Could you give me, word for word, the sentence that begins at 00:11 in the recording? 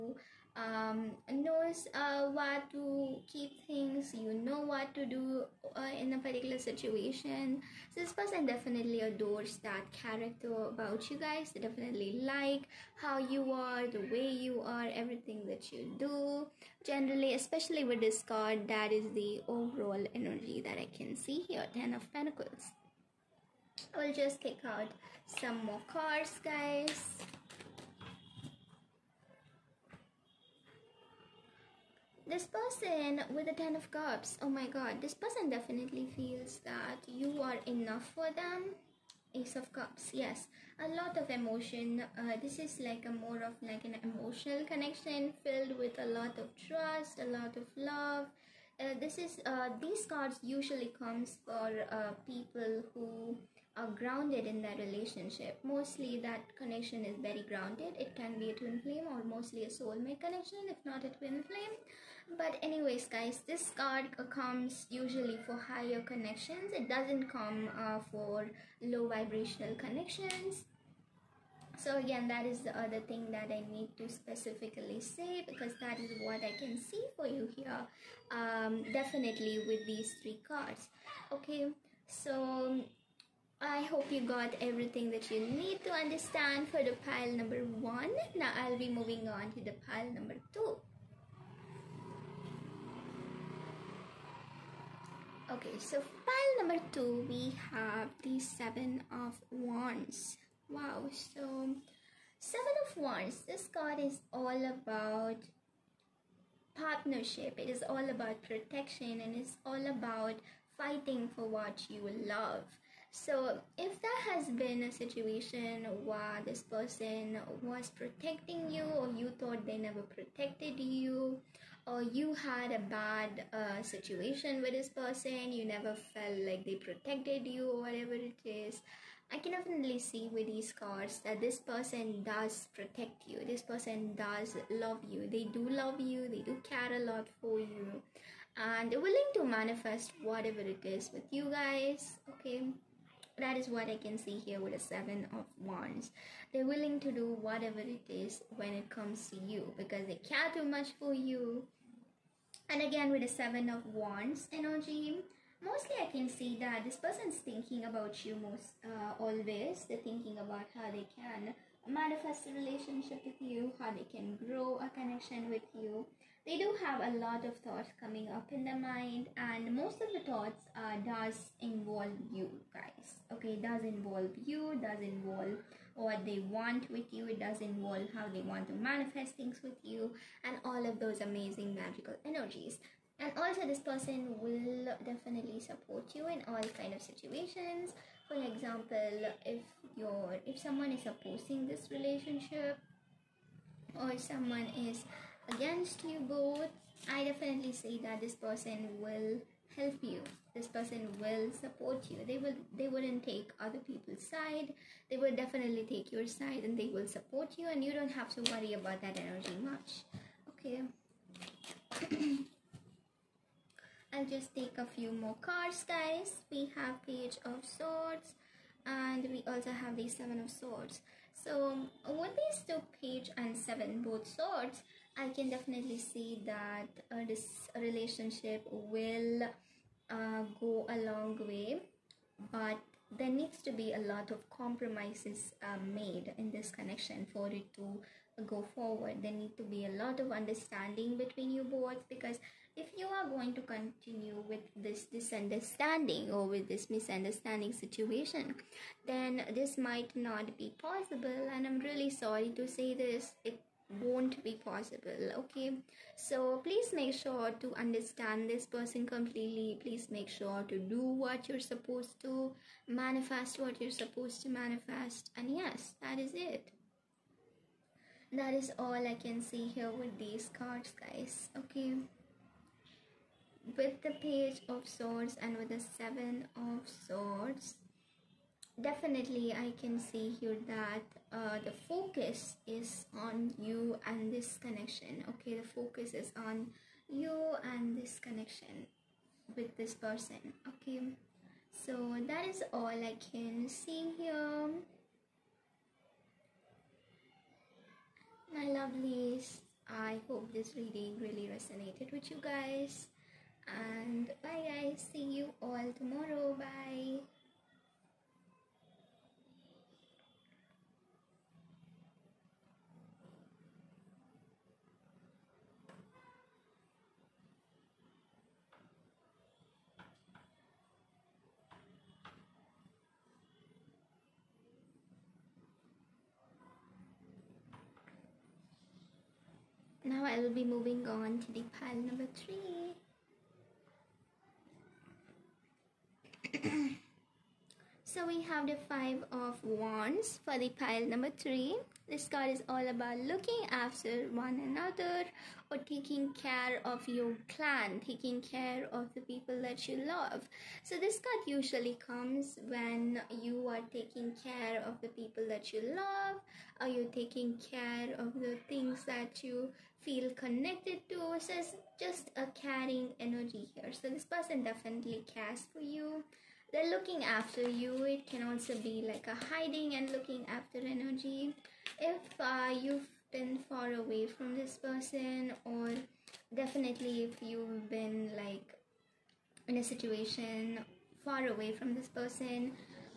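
They definitely like how you are, the way you are, everything that you do.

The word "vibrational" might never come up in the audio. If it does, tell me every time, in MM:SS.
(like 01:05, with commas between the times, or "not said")
01:09.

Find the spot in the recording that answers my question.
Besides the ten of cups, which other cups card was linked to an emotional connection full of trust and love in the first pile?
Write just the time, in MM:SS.
00:39.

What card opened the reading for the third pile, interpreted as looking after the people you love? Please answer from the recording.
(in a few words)
Five of Wands.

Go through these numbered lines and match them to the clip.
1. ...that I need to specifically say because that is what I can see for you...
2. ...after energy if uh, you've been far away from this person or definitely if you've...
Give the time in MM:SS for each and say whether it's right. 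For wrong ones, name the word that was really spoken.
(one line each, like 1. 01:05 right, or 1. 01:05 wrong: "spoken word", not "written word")
1. 01:13 right
2. 06:10 right.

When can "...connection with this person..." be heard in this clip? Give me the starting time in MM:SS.
04:48.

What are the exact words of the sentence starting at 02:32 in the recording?
And again, with the Seven of Wands energy, mostly I can see that this person's thinking about you most uh, always.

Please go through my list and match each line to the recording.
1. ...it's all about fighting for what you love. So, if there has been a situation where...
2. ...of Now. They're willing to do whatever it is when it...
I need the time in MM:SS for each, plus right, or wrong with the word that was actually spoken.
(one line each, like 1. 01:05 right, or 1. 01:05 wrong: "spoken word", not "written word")
1. 01:49 right
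2. 02:25 wrong: "Wands", not "Now".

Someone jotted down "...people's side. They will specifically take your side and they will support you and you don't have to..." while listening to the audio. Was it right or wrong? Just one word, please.
wrong.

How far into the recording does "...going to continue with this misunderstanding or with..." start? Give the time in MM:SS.
04:03.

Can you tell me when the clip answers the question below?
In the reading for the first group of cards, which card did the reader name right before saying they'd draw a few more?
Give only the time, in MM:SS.
00:21.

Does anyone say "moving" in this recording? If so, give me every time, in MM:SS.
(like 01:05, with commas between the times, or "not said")
01:28, 05:30.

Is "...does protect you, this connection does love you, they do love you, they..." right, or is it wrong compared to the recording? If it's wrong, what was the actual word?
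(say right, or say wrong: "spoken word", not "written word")
wrong: "person", not "connection".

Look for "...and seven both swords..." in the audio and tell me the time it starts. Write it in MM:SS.
03:43.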